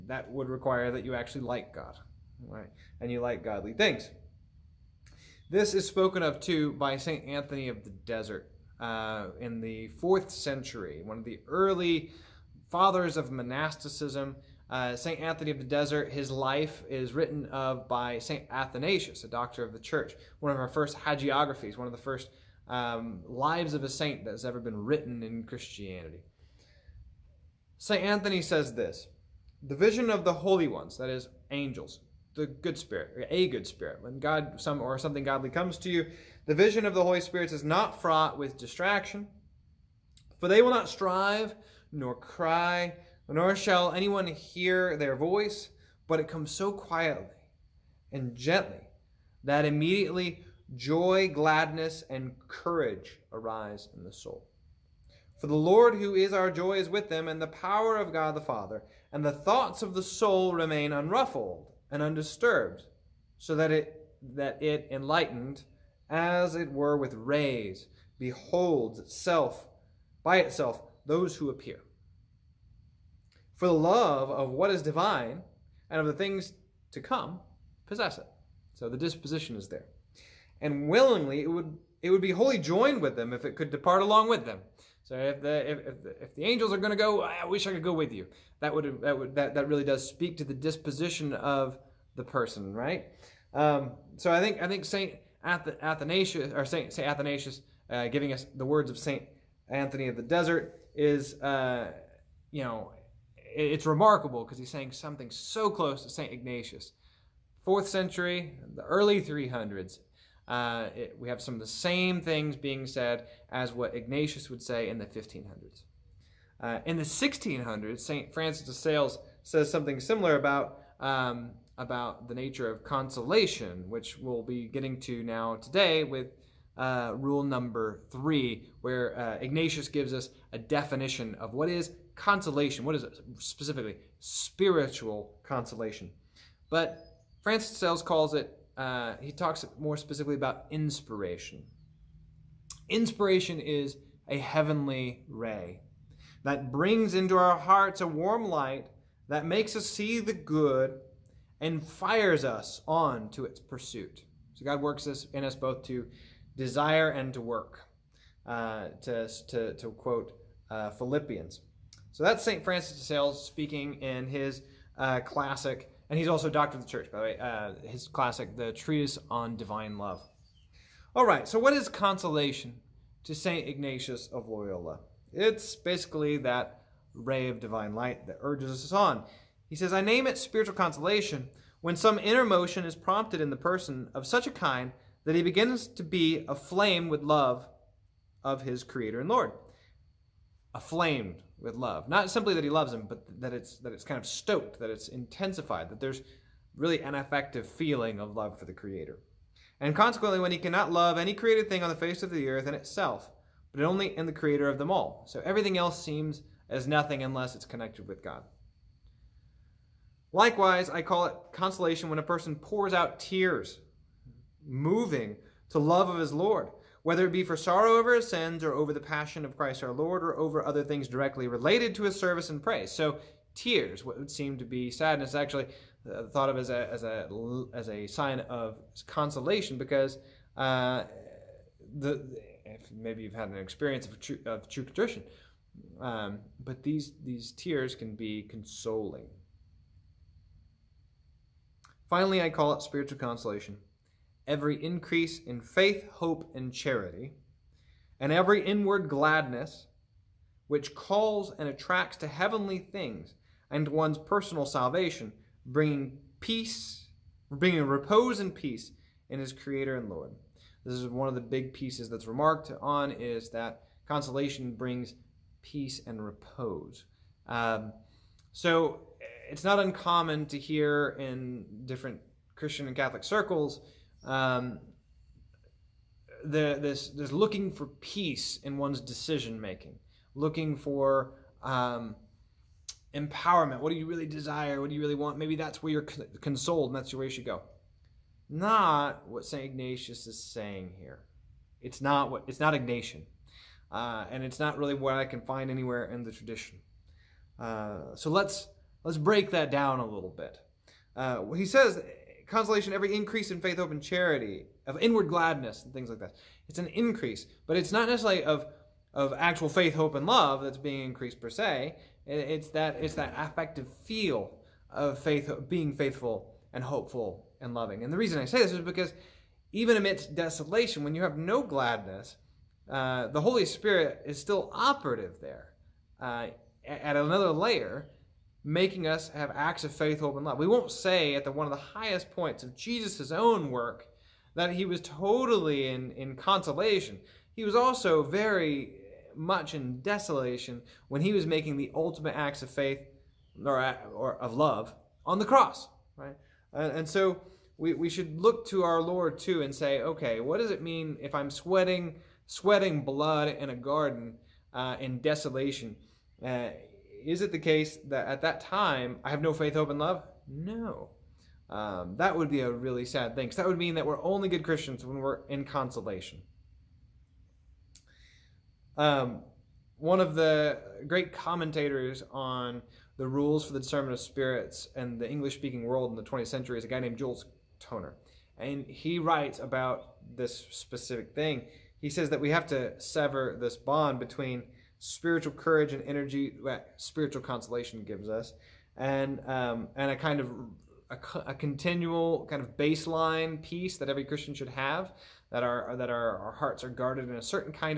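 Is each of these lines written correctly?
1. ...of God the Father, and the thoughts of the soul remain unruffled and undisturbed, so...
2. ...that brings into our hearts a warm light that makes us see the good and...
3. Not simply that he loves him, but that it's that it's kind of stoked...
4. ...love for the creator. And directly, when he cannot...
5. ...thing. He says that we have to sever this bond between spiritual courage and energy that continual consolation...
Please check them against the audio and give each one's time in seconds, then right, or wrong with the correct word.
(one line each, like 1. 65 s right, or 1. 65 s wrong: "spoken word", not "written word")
1. 57 s right
2. 146 s right
3. 192 s right
4. 198 s wrong: "consequently", not "directly"
5. 381 s wrong: "spiritual", not "continual".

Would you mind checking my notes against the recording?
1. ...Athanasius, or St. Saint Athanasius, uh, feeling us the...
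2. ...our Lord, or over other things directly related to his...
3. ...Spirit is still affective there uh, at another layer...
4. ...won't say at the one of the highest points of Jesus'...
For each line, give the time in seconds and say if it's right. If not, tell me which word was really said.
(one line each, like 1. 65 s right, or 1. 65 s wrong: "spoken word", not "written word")
1. 95 s wrong: "giving", not "feeling"
2. 219 s right
3. 323 s wrong: "operative", not "affective"
4. 330 s right.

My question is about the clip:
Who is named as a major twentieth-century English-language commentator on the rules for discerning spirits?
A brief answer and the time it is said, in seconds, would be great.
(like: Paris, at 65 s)
Jules Toner, at 377 s.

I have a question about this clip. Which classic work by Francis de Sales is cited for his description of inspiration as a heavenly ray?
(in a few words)
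The Treatise on Divine Love.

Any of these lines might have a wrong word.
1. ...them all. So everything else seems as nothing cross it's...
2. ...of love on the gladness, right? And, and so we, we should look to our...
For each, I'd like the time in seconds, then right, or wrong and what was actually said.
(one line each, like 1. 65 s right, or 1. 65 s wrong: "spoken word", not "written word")
1. 204 s wrong: "unless", not "cross"
2. 344 s wrong: "cross", not "gladness".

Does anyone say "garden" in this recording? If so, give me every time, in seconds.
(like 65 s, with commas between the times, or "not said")
353 s.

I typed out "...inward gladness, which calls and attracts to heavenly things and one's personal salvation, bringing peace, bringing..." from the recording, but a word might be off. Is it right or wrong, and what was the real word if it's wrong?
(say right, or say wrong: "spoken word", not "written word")
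right.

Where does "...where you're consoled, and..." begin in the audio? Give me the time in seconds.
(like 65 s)
285 s.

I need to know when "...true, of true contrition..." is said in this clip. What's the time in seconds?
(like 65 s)
234 s.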